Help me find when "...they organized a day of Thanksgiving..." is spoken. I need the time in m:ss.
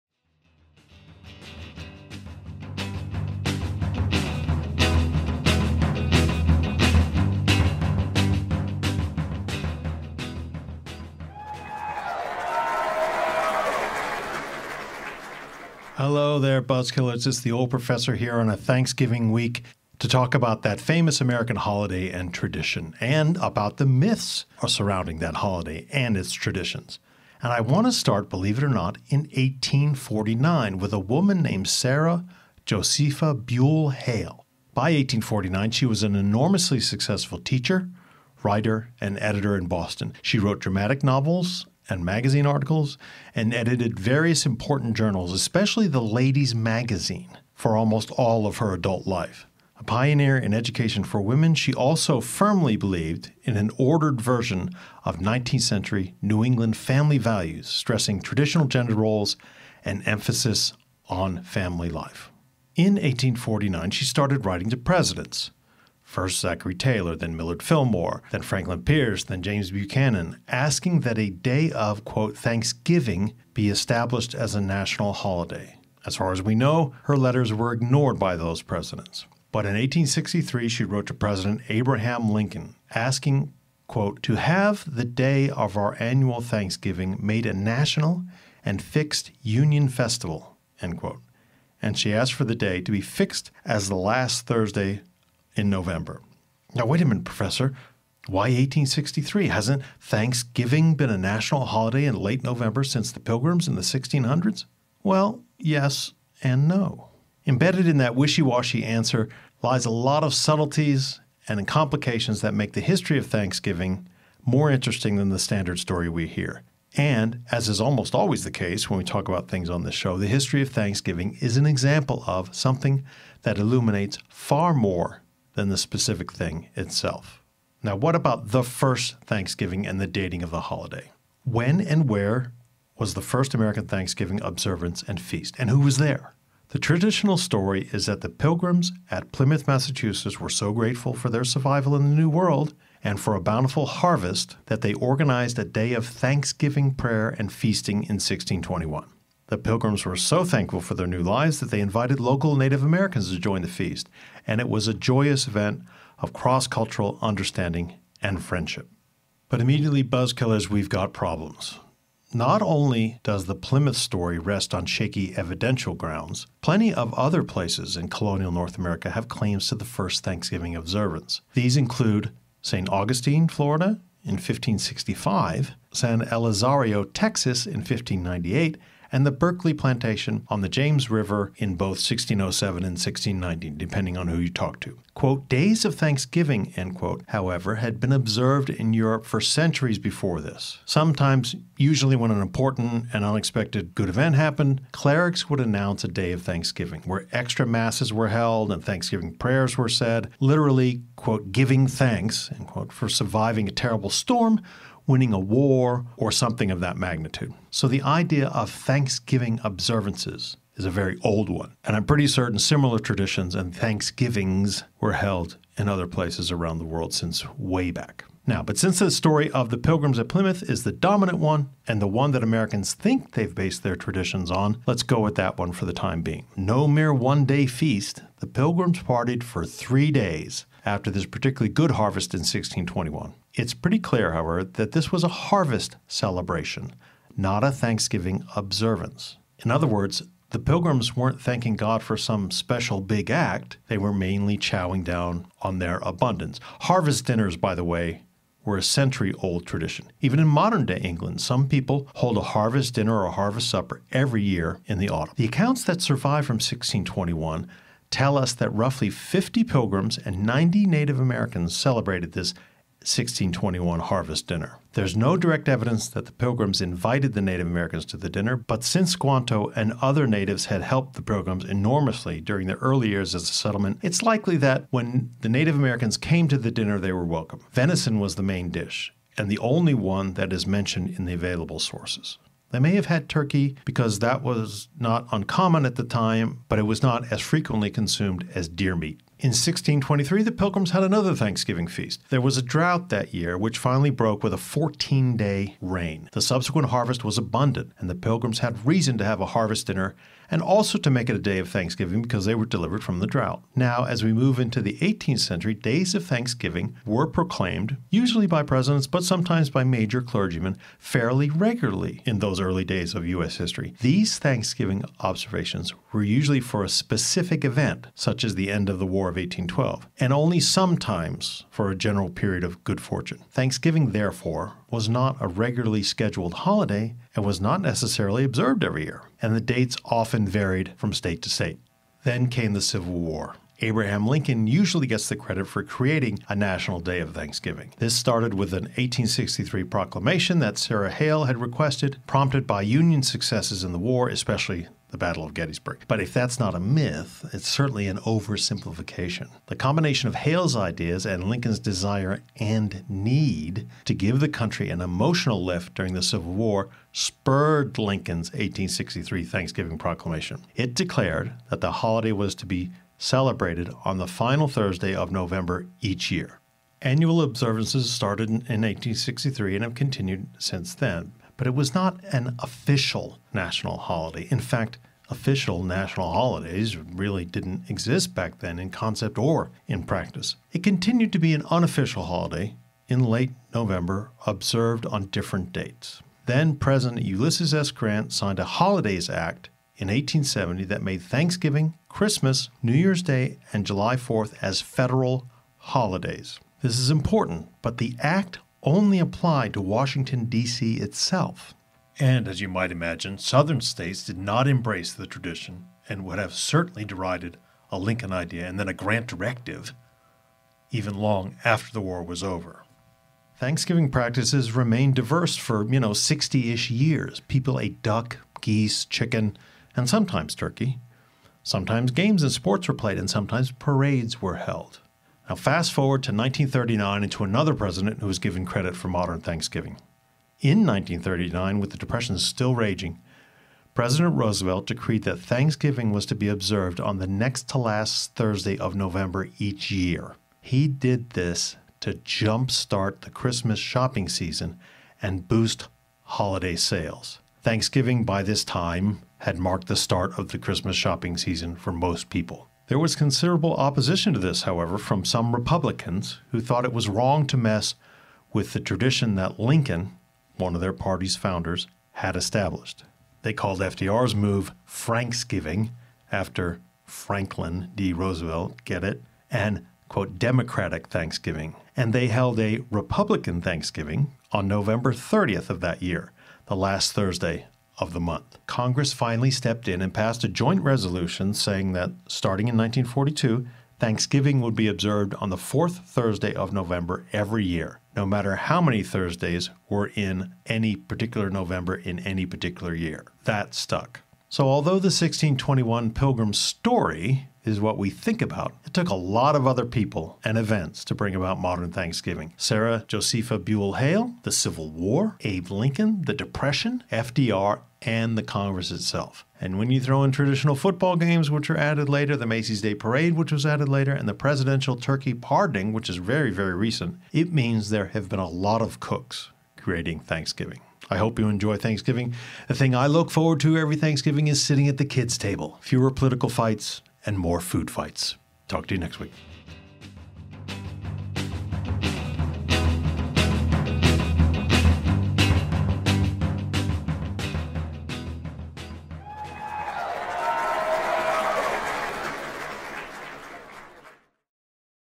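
2:24.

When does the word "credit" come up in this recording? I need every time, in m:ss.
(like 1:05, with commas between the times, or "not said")
5:35, 7:08.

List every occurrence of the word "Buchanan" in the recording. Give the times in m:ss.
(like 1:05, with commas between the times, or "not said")
1:09.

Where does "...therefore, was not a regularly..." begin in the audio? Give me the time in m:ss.
5:24.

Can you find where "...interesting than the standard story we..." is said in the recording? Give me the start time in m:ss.
1:54.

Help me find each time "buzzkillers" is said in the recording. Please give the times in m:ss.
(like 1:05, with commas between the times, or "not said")
0:16, 2:40.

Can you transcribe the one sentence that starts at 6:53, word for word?
Thanksgiving practices remained diverse for, you know, 60 ish years.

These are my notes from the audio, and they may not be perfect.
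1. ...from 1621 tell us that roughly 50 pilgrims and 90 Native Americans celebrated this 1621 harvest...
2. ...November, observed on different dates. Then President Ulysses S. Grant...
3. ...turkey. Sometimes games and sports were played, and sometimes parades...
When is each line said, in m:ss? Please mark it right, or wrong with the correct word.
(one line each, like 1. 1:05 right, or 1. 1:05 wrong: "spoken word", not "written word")
1. 4:16 right
2. 6:23 right
3. 7:00 right.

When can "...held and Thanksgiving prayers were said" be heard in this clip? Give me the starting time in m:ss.
3:18.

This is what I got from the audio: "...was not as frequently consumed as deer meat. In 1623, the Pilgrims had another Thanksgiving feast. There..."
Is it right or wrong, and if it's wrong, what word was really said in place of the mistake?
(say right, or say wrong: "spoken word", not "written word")
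right.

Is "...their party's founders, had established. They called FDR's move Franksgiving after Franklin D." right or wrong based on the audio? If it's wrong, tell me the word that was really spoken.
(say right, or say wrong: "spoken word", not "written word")
right.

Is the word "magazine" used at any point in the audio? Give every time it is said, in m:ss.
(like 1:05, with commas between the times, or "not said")
0:42, 0:46.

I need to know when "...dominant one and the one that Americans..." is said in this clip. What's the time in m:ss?
3:40.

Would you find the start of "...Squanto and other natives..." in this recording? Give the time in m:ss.
4:29.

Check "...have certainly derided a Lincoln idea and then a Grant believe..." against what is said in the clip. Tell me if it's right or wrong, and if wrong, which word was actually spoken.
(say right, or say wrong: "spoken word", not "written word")
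wrong: "directive", not "believe".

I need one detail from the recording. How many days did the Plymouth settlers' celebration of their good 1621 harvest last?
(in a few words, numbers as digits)
3 days.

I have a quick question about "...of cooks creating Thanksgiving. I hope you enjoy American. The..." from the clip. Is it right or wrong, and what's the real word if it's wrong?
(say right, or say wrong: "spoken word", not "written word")
wrong: "Thanksgiving", not "American".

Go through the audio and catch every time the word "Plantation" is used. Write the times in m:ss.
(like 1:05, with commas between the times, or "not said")
2:59.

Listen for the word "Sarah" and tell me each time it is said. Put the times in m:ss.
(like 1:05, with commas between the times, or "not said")
0:31, 5:40, 8:22.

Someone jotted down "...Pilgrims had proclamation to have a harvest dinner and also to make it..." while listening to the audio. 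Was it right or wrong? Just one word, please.
wrong.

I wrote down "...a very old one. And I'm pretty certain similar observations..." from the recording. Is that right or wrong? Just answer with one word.
wrong.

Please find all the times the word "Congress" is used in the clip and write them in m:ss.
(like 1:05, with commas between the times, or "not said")
7:58, 8:28.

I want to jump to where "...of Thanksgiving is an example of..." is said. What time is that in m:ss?
2:00.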